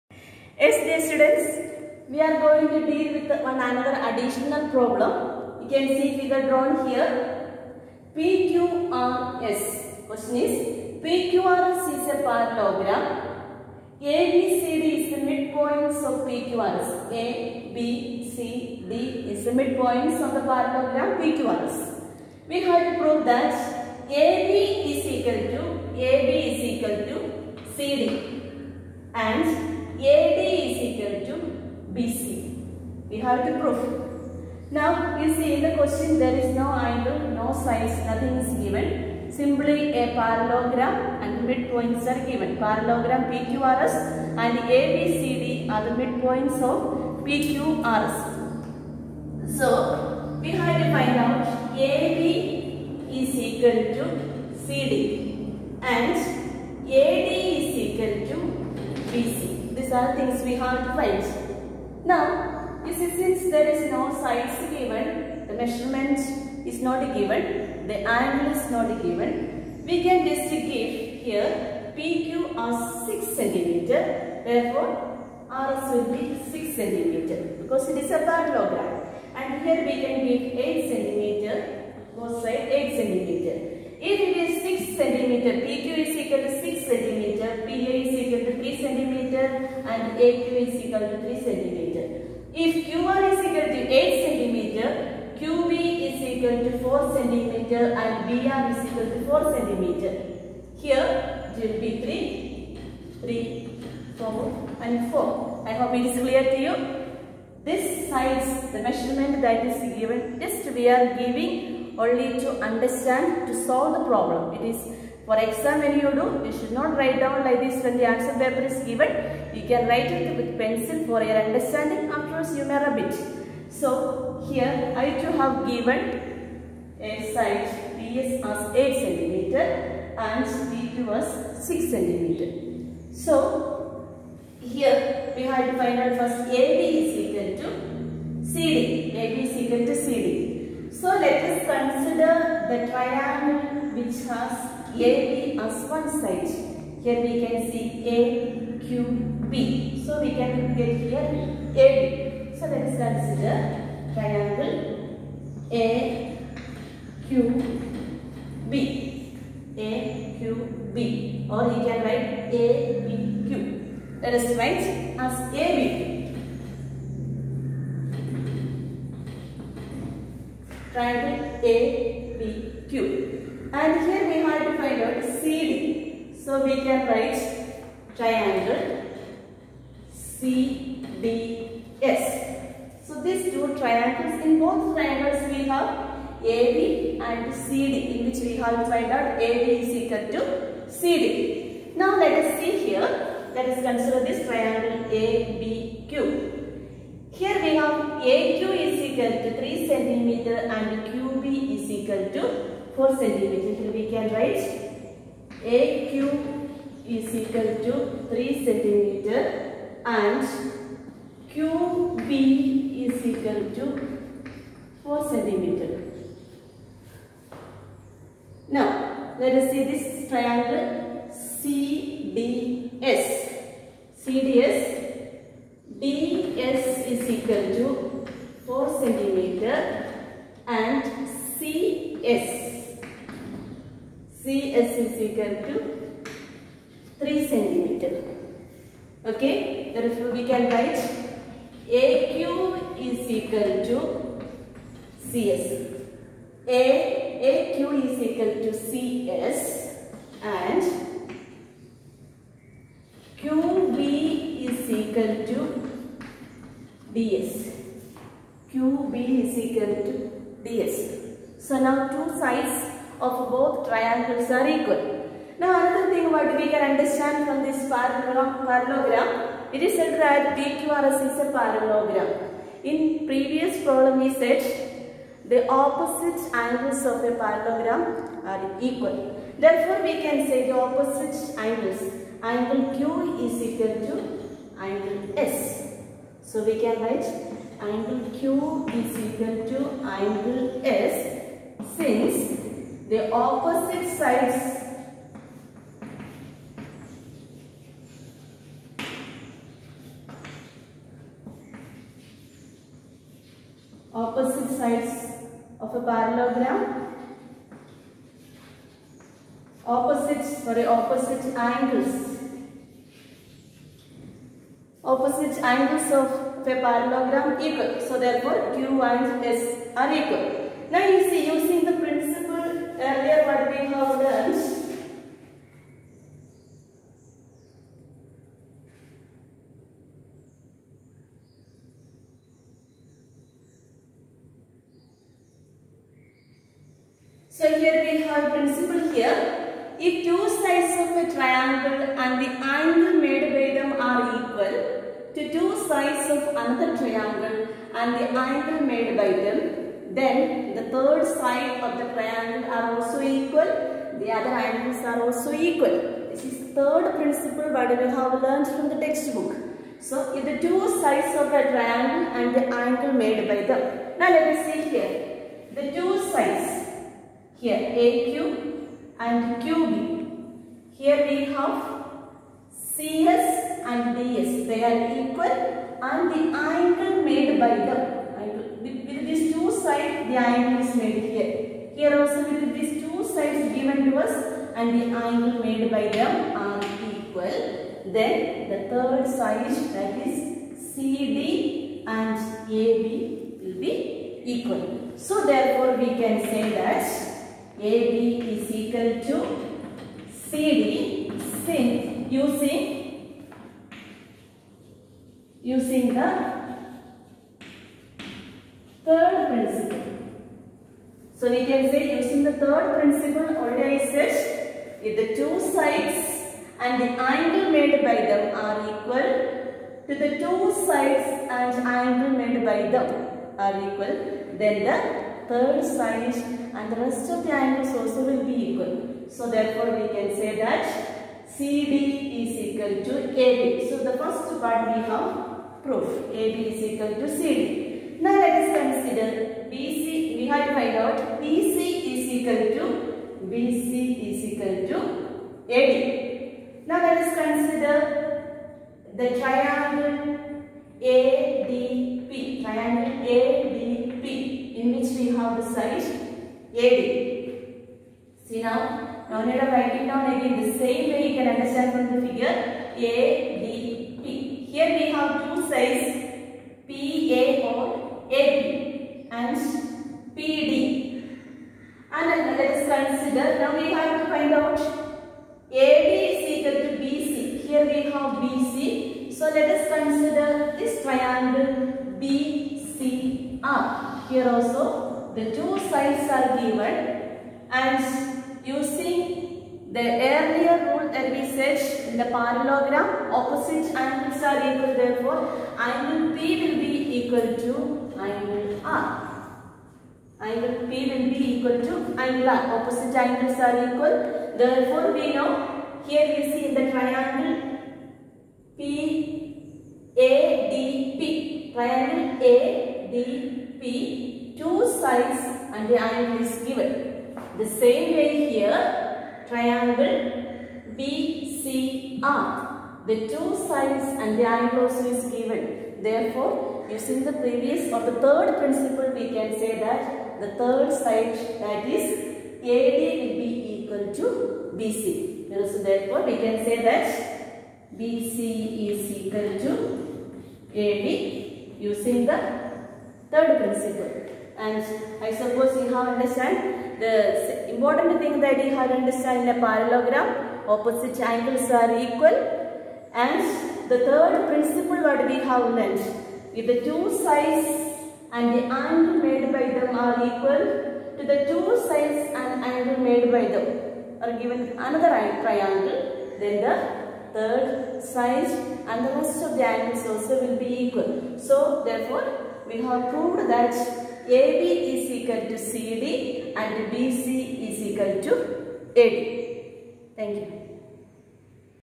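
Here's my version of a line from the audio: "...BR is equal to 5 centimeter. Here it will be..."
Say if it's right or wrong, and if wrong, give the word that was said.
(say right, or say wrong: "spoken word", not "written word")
wrong: "4", not "5".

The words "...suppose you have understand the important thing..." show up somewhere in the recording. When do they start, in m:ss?
9:05.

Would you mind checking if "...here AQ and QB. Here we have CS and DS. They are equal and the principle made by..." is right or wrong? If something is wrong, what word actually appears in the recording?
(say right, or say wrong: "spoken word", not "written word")
wrong: "angle", not "principle".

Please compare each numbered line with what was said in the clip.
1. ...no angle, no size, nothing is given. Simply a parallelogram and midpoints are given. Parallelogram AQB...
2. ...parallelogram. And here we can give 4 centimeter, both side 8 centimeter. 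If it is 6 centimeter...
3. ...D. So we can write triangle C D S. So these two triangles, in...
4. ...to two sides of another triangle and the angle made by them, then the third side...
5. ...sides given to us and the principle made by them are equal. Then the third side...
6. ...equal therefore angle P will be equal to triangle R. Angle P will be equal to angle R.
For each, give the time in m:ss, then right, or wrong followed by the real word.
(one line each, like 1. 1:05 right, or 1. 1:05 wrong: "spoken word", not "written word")
1. 0:36 wrong: "PQRS", not "AQB"
2. 1:18 wrong: "8", not "4"
3. 2:55 right
4. 5:45 right
5. 6:23 wrong: "angle", not "principle"
6. 8:14 wrong: "angle", not "triangle".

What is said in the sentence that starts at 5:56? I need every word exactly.
This is the third principle what we have learned from the textbook.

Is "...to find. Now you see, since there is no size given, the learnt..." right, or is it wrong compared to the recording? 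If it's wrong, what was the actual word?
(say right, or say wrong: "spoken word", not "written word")
wrong: "measurement", not "learnt".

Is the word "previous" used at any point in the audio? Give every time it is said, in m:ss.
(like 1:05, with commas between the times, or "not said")
4:33, 8:47.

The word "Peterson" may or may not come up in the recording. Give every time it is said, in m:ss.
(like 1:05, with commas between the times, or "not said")
not said.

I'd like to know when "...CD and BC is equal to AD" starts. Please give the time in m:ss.
9:35.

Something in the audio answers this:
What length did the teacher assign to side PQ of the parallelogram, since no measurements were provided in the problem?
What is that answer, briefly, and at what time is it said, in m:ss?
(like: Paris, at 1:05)
6 cm, at 1:11.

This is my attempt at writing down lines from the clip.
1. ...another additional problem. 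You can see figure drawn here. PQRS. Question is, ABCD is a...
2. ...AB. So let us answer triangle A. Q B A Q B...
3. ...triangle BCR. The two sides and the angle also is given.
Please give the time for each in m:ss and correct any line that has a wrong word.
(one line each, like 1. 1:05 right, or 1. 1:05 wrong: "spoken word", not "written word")
1. 0:03 wrong: "PQRS", not "ABCD"
2. 2:31 wrong: "consider", not "answer"
3. 8:39 right.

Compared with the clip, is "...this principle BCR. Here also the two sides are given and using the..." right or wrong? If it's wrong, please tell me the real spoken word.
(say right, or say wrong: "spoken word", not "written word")
wrong: "triangle", not "principle".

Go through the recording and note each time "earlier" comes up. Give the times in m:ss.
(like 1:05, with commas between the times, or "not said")
5:23, 8:10.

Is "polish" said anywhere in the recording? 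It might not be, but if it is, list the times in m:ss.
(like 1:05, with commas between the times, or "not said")
not said.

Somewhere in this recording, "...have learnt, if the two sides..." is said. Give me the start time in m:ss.
9:15.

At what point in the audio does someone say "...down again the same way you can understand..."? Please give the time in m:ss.
7:40.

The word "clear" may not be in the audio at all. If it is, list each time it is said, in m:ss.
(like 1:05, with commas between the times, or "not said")
1:46.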